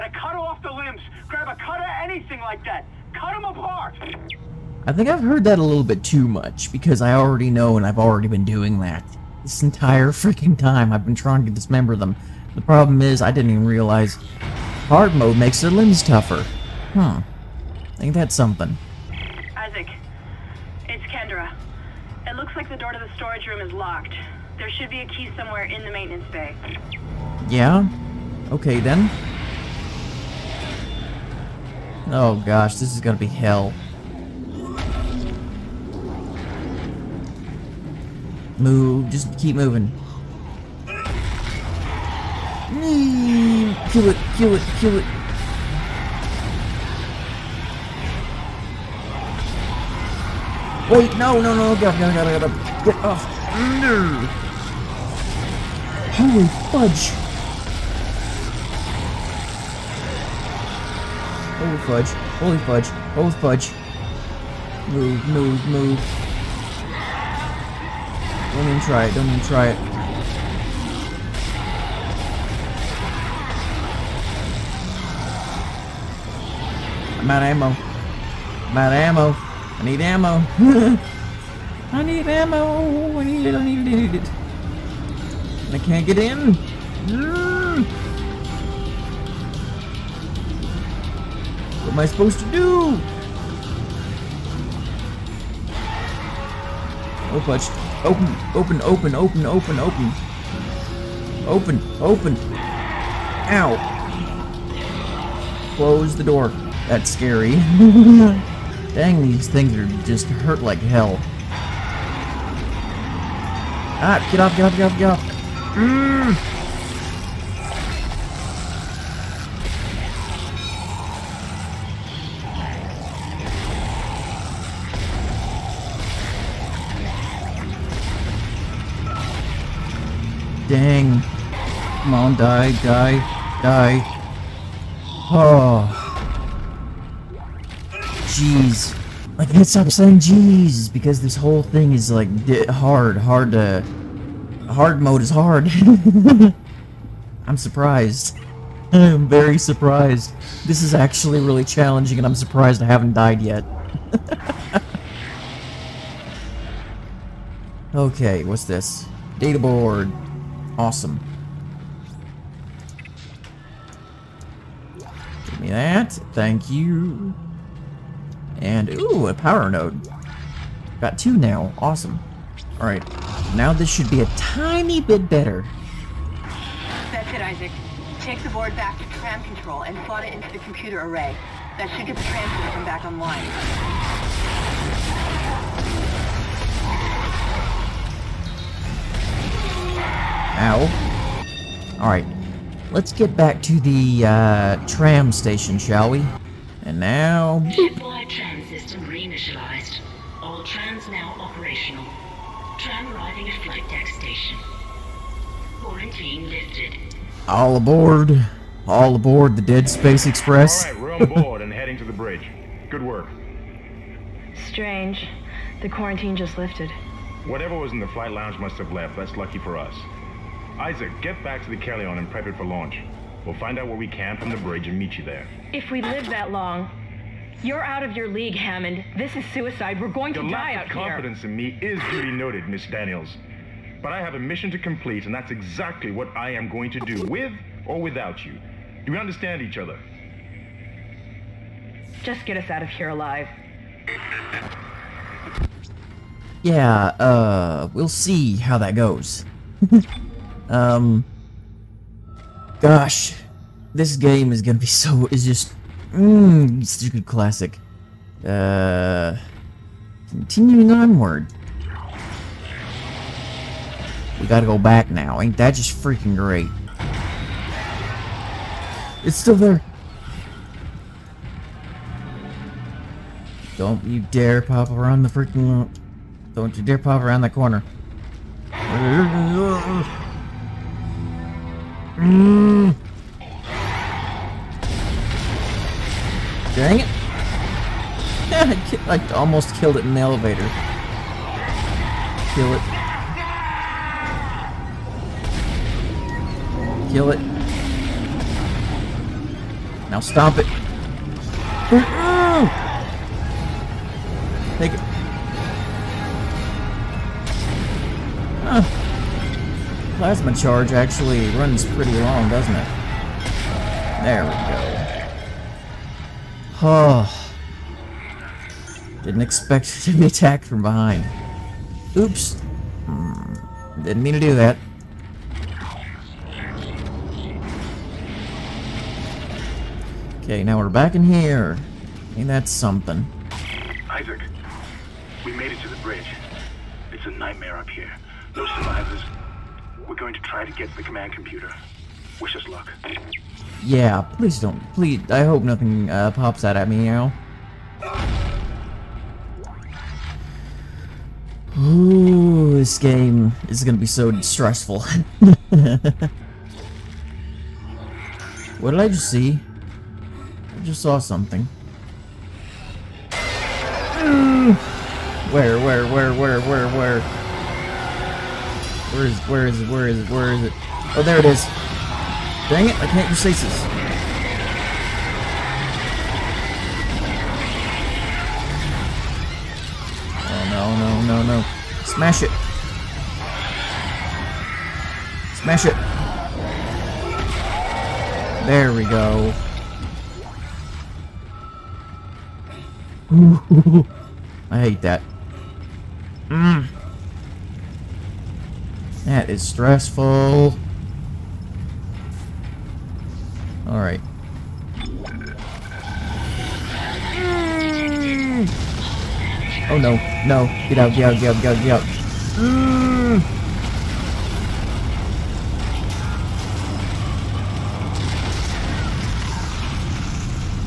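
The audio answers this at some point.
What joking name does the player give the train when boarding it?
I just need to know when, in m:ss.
3:29.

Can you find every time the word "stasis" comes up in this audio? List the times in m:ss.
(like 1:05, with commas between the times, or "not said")
6:13.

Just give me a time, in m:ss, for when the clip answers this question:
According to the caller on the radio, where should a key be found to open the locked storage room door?
0:25.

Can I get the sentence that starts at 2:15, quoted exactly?
Oh like I can't stop saying jeez because this whole thing is like hard, hard to.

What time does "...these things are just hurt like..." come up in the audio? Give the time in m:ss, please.
1:49.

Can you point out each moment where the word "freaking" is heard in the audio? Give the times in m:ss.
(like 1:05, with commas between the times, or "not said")
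0:10, 4:25, 4:35.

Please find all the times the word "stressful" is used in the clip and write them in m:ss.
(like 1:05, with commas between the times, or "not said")
5:54, 6:39.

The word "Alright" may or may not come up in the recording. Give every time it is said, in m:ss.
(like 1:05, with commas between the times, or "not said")
2:52, 3:12.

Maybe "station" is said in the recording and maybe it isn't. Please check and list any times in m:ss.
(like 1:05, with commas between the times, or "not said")
3:15, 3:24.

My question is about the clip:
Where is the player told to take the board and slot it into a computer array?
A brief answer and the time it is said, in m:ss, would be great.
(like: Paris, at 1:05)
tram control, at 2:59.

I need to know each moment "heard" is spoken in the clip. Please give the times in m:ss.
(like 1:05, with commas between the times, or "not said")
0:05.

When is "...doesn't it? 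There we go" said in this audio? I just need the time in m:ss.
5:12.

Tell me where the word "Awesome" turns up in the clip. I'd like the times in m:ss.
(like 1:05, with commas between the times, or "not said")
2:40, 2:51.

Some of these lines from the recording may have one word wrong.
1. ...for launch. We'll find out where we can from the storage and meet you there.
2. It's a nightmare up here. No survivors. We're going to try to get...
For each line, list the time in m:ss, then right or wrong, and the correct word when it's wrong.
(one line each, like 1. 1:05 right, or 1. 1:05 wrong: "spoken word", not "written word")
1. 3:42 wrong: "bridge", not "storage"
2. 5:37 right.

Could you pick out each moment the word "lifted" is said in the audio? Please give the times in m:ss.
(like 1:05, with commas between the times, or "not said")
3:26, 3:36.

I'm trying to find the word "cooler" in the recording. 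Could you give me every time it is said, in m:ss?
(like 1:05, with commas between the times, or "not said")
not said.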